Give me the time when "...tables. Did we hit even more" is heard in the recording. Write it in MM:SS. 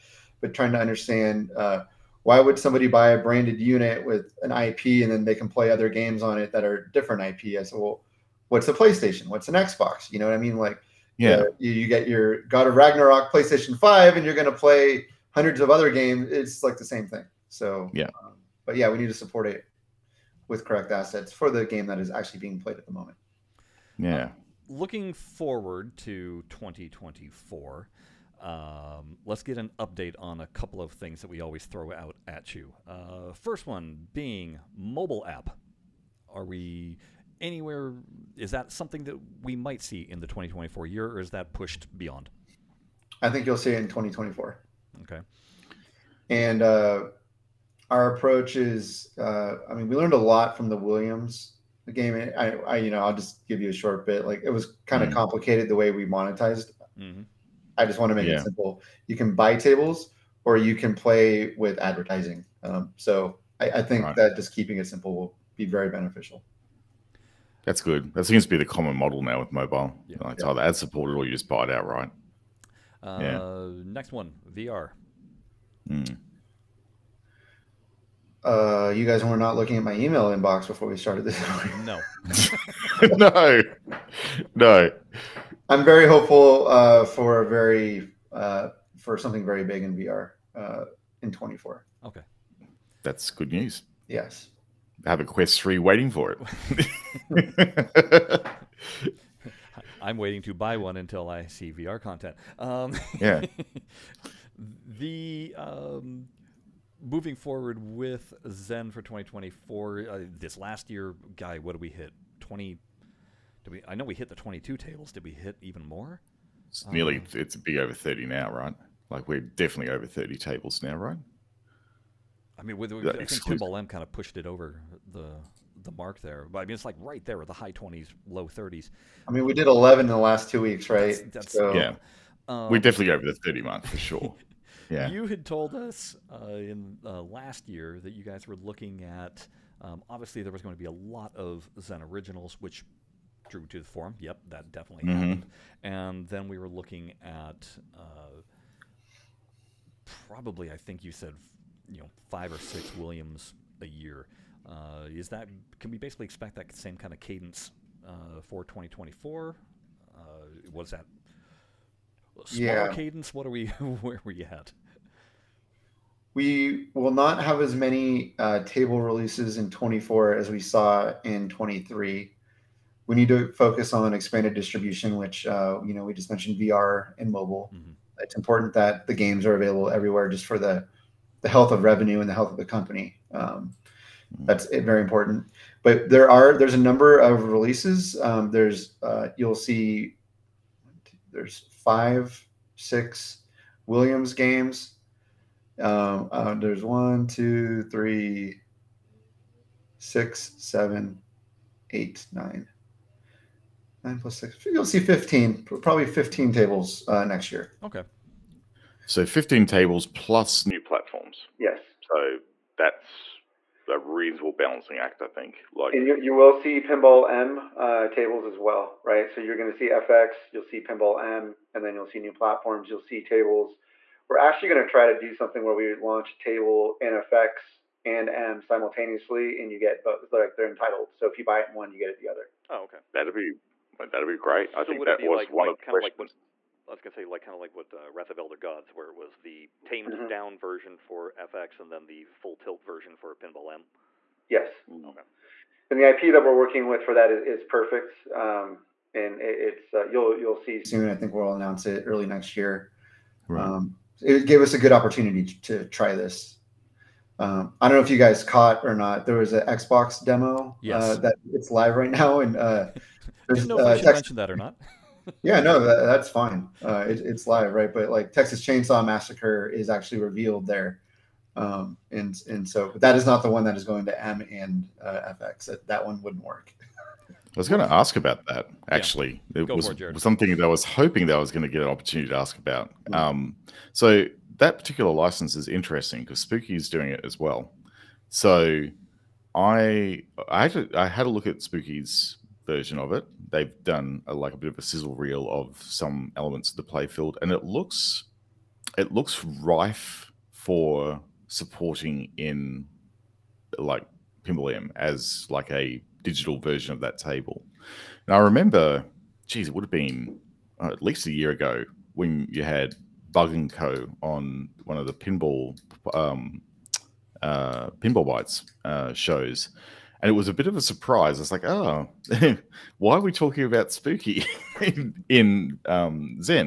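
01:54.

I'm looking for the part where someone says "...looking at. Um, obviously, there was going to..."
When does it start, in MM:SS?
02:18.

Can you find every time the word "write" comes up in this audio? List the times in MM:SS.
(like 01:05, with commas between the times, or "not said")
not said.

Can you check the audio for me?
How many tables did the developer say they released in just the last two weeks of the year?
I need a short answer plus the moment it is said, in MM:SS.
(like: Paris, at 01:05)
11, at 02:09.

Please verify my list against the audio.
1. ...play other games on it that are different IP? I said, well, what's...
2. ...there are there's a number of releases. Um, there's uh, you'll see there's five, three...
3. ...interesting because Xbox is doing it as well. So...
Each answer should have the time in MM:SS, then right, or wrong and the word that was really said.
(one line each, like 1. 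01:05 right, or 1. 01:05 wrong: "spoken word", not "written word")
1. 00:05 right
2. 03:06 wrong: "six", not "three"
3. 04:45 wrong: "Spooky", not "Xbox".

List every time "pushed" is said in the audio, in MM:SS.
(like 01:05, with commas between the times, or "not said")
00:41, 02:04.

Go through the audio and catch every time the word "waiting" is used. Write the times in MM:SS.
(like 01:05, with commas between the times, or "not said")
01:35, 01:40.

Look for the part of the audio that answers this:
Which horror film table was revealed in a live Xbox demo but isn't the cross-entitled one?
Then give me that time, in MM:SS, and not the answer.
04:28.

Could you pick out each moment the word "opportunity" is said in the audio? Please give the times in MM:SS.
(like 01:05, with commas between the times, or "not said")
04:14, 04:41.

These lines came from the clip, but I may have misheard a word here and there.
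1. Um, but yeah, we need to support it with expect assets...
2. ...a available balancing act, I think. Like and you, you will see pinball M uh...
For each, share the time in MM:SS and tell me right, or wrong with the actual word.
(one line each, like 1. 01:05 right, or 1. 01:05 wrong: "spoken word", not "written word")
1. 00:18 wrong: "correct", not "expect"
2. 03:33 wrong: "reasonable", not "available".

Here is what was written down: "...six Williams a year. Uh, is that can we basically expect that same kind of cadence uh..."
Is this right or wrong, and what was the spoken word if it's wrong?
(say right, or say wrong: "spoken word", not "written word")
right.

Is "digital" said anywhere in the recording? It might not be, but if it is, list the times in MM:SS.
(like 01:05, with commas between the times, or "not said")
05:06.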